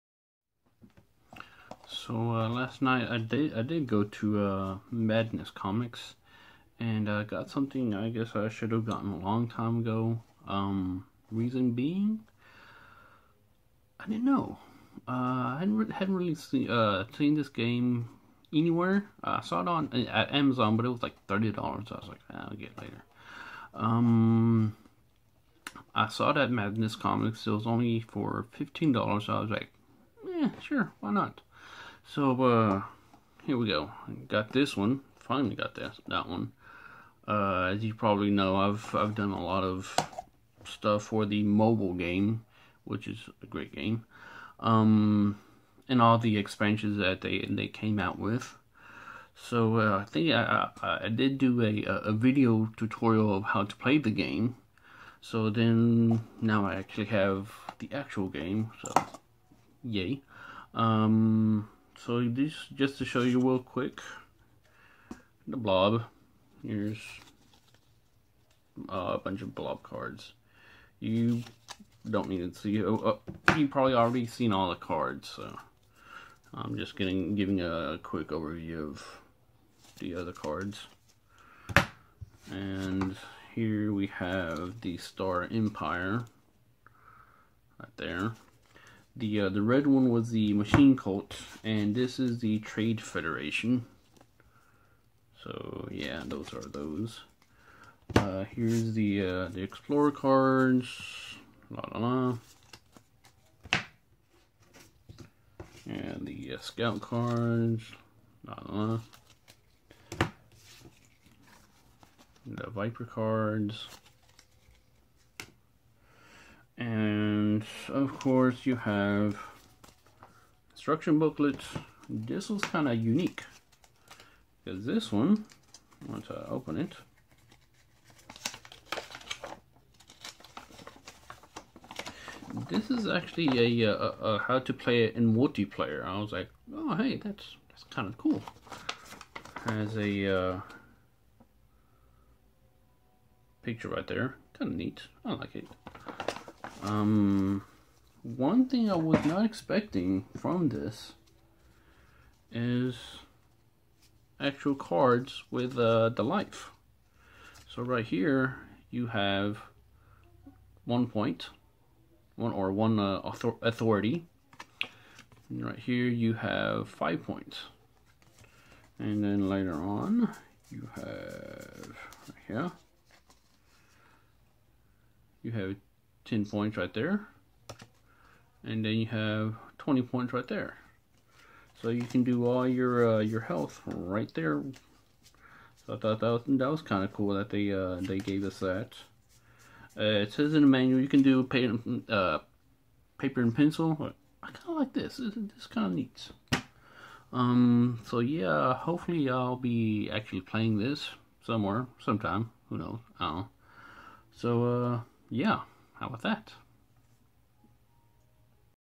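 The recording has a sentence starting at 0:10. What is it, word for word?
Um, reason being, I didn't know.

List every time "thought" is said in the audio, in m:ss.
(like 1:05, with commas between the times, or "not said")
3:05.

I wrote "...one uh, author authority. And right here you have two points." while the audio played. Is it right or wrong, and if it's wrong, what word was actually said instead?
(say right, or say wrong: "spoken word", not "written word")
wrong: "five", not "two".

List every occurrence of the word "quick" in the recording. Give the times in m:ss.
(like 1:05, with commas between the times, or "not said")
1:03, 1:18.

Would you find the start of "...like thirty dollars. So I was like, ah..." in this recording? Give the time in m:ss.
0:21.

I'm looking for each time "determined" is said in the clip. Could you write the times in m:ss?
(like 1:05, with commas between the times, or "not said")
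not said.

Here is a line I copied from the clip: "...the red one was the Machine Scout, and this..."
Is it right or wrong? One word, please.
wrong.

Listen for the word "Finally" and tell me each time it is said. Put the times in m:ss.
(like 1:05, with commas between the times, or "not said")
0:35.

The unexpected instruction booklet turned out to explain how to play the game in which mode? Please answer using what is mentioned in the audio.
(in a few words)
Multiplayer.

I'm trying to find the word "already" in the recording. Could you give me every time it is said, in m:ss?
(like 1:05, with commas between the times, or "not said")
1:13.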